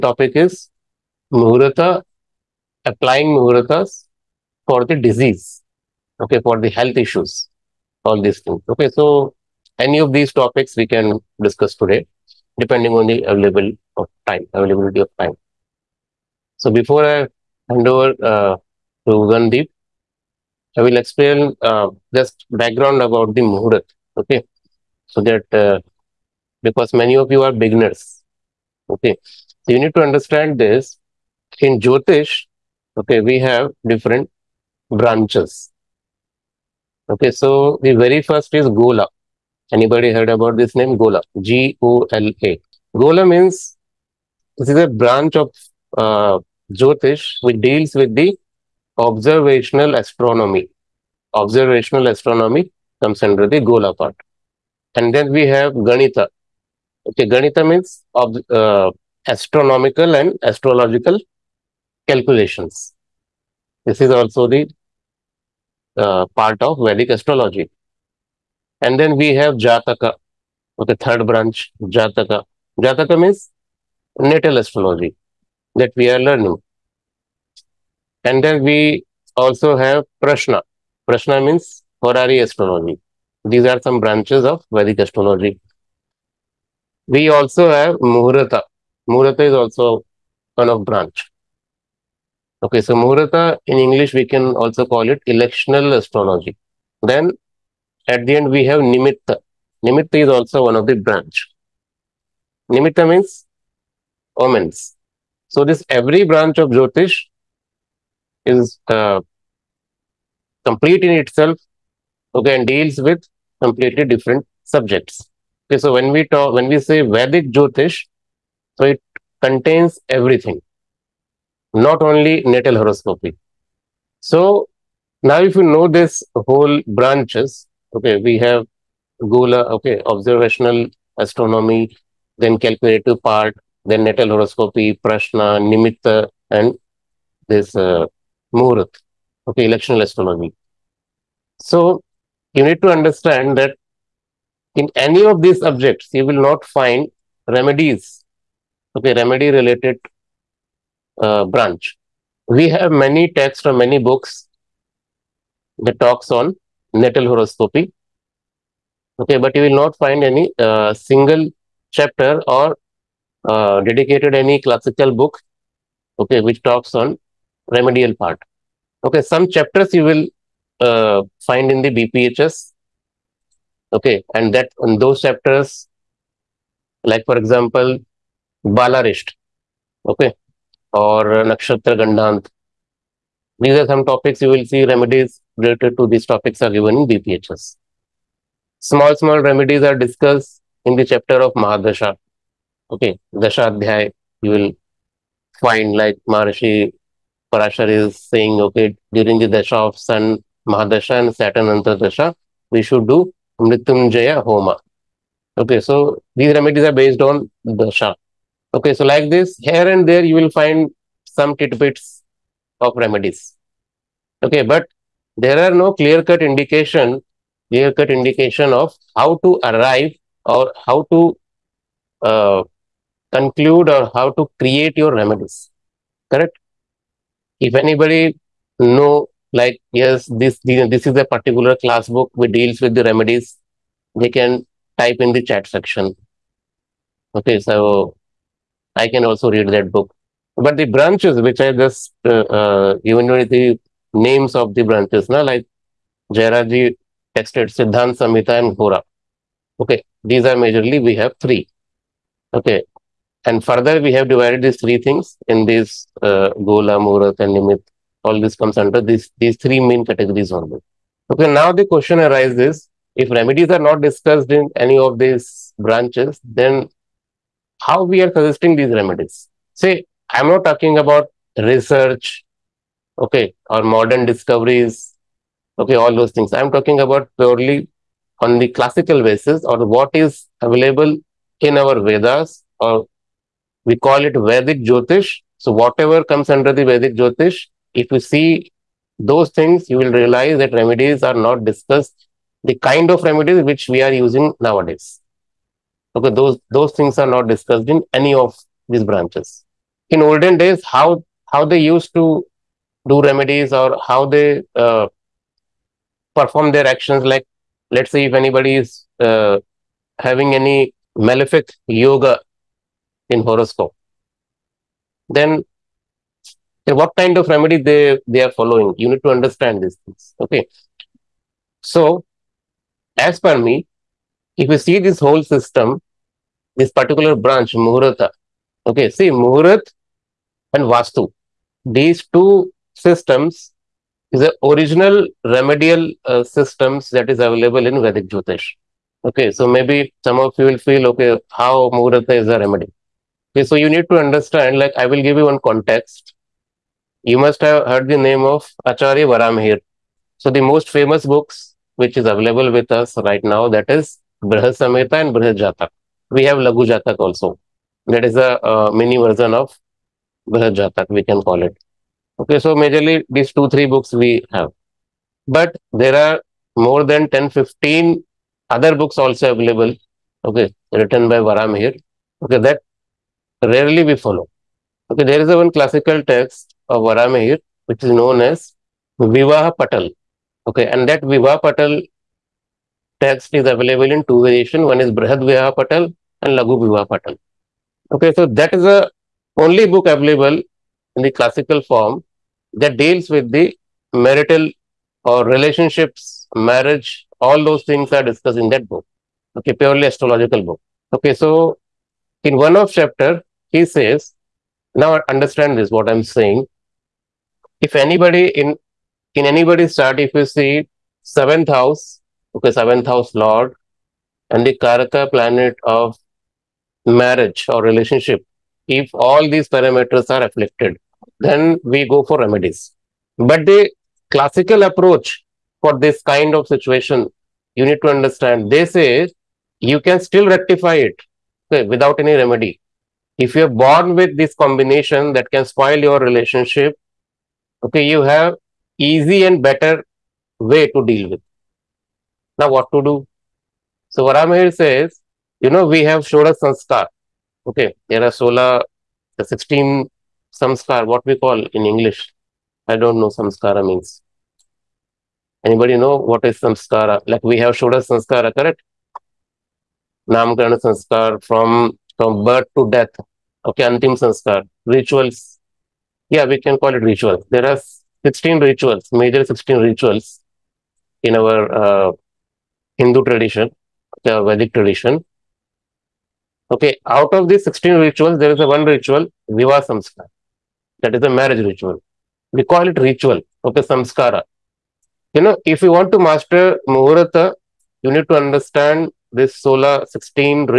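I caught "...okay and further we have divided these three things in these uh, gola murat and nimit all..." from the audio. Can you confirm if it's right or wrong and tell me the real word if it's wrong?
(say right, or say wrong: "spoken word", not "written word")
right.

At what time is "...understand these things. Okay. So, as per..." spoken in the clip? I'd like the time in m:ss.
5:19.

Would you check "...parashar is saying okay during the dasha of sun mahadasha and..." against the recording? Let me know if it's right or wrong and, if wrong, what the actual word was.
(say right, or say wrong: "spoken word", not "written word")
right.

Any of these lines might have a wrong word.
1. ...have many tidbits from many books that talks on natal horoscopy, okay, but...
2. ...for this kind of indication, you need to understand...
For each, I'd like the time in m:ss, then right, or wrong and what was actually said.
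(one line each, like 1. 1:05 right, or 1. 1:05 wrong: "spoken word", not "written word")
1. 2:32 wrong: "texts", not "tidbits"
2. 7:05 wrong: "situation", not "indication".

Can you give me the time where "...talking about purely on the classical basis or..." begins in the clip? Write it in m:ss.
4:36.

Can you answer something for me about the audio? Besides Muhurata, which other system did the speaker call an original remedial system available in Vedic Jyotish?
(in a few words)
Vastu.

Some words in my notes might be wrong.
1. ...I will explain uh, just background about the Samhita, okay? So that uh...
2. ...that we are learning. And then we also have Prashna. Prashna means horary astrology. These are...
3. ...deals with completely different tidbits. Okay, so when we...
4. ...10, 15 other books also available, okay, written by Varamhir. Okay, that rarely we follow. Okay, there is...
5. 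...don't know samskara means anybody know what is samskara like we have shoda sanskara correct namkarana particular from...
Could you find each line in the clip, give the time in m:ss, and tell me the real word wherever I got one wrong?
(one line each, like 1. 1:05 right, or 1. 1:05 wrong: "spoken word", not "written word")
1. 0:20 wrong: "Muhurat", not "Samhita"
2. 1:15 right
3. 1:52 wrong: "subjects", not "tidbits"
4. 6:07 right
5. 7:33 wrong: "sanskar", not "particular".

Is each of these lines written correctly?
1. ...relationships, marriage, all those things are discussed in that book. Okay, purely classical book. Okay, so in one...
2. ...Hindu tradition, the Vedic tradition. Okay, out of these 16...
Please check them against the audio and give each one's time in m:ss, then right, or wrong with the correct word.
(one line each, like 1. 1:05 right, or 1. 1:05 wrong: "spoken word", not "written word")
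1. 6:35 wrong: "astrological", not "classical"
2. 7:52 right.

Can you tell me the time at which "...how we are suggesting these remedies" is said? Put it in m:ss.
4:27.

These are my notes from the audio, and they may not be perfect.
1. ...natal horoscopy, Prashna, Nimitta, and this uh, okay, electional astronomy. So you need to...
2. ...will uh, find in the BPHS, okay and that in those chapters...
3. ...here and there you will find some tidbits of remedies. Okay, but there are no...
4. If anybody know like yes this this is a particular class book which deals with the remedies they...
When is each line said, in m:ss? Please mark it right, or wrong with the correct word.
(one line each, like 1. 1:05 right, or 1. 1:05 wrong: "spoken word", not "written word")
1. 2:14 right
2. 2:50 right
3. 3:29 right
4. 3:47 right.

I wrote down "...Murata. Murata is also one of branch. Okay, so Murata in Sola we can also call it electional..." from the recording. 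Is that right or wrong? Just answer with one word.
wrong.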